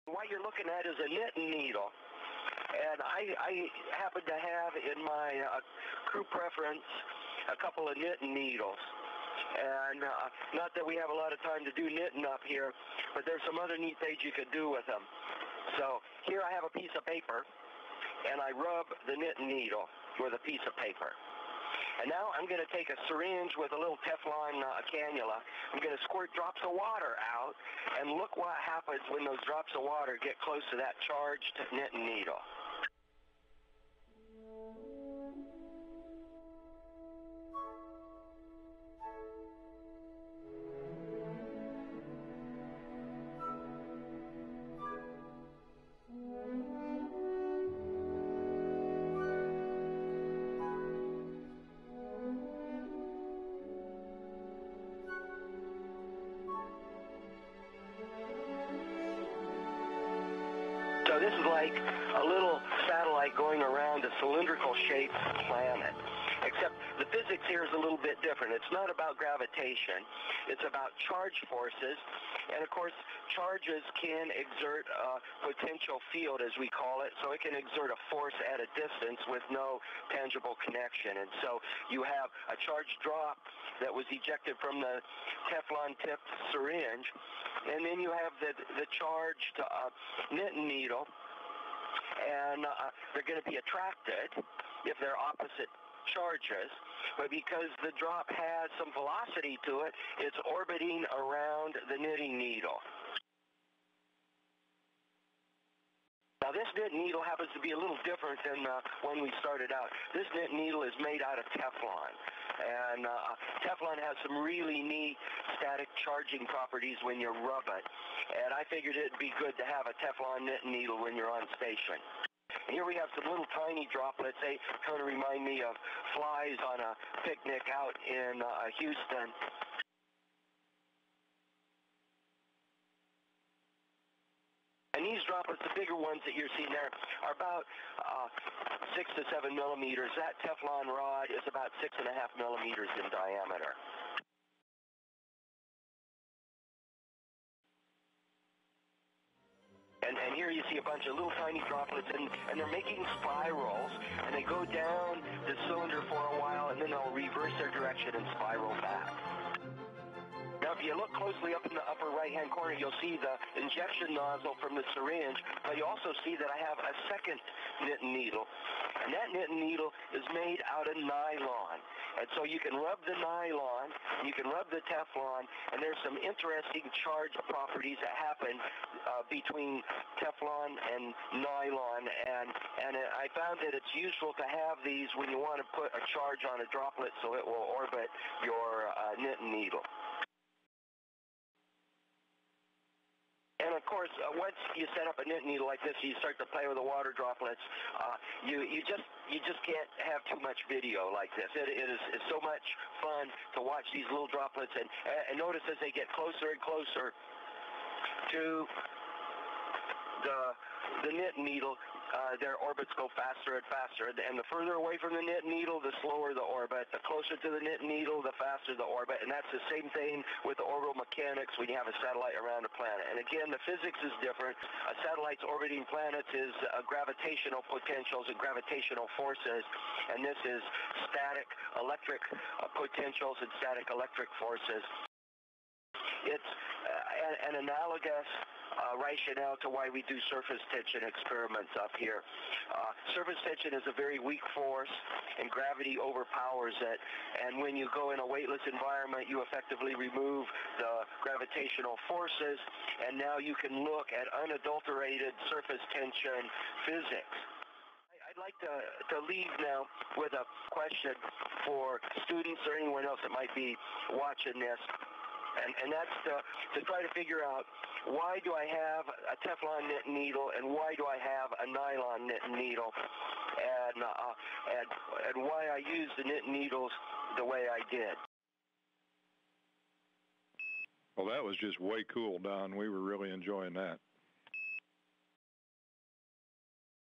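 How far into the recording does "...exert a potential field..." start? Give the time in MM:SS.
01:14.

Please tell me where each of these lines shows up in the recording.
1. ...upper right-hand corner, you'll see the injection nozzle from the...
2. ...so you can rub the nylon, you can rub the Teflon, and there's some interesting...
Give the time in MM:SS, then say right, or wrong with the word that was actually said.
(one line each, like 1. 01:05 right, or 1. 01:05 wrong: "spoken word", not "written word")
1. 02:41 right
2. 02:52 right.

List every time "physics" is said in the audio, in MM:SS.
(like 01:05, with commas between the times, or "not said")
01:07, 03:43, 04:16.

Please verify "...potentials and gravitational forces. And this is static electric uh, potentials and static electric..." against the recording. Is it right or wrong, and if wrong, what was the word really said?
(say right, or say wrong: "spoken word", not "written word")
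right.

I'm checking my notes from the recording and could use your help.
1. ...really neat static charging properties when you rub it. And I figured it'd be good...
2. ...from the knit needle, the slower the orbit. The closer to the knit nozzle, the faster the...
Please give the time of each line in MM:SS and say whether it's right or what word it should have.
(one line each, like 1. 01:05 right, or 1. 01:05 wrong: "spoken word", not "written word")
1. 01:54 right
2. 03:35 wrong: "needle", not "nozzle".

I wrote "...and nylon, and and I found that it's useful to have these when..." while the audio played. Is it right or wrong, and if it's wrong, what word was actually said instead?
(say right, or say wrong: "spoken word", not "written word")
right.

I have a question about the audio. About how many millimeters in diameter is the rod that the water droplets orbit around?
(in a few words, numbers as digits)
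6.5 millimeters.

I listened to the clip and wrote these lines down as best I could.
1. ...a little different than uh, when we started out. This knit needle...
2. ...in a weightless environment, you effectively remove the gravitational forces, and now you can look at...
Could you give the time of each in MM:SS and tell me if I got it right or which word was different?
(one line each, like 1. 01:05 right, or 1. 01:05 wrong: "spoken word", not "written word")
1. 01:47 right
2. 04:08 right.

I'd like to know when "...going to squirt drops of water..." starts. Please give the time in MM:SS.
00:25.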